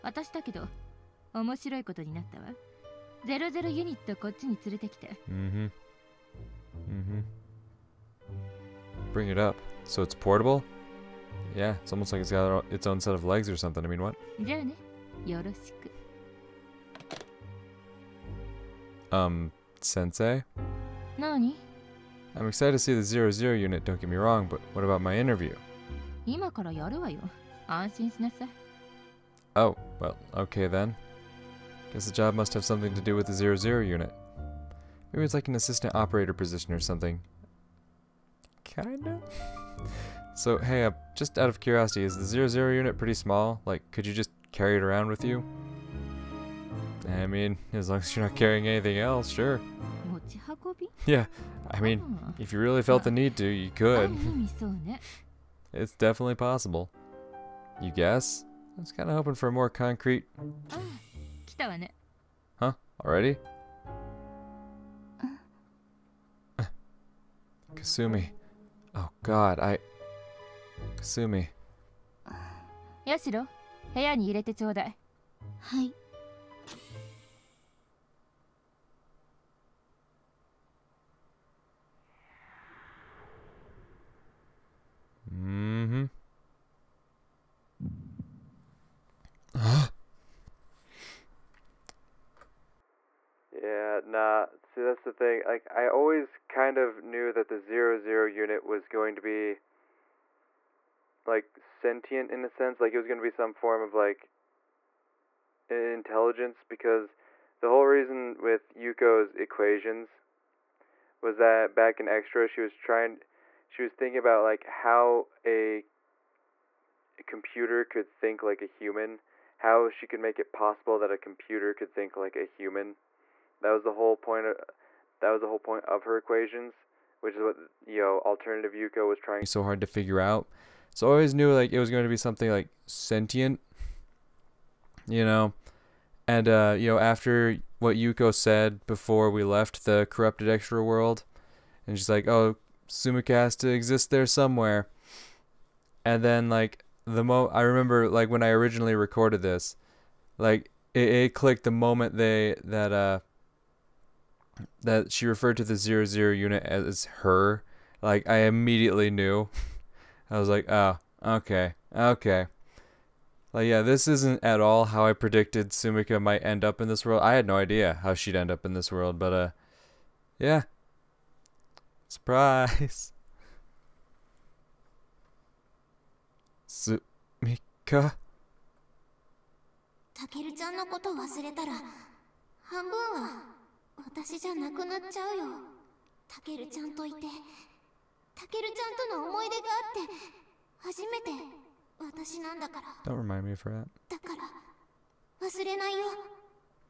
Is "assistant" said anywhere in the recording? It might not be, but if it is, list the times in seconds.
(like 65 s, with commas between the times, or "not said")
35 s.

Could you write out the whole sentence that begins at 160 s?
I was like, oh, okay, okay.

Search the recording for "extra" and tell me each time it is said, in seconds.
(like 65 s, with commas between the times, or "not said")
112 s, 140 s.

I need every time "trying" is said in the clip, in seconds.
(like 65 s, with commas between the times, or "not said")
112 s, 129 s.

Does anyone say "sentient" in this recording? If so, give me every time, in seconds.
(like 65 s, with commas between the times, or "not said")
101 s, 132 s.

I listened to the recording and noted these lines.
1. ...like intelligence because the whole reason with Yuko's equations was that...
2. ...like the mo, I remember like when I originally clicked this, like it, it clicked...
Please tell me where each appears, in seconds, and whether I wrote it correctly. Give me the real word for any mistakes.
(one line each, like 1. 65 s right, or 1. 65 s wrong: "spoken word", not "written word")
1. 103 s right
2. 146 s wrong: "recorded", not "clicked".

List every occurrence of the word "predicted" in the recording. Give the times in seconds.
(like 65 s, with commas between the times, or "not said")
165 s.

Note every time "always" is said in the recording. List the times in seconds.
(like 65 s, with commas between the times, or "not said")
95 s, 131 s.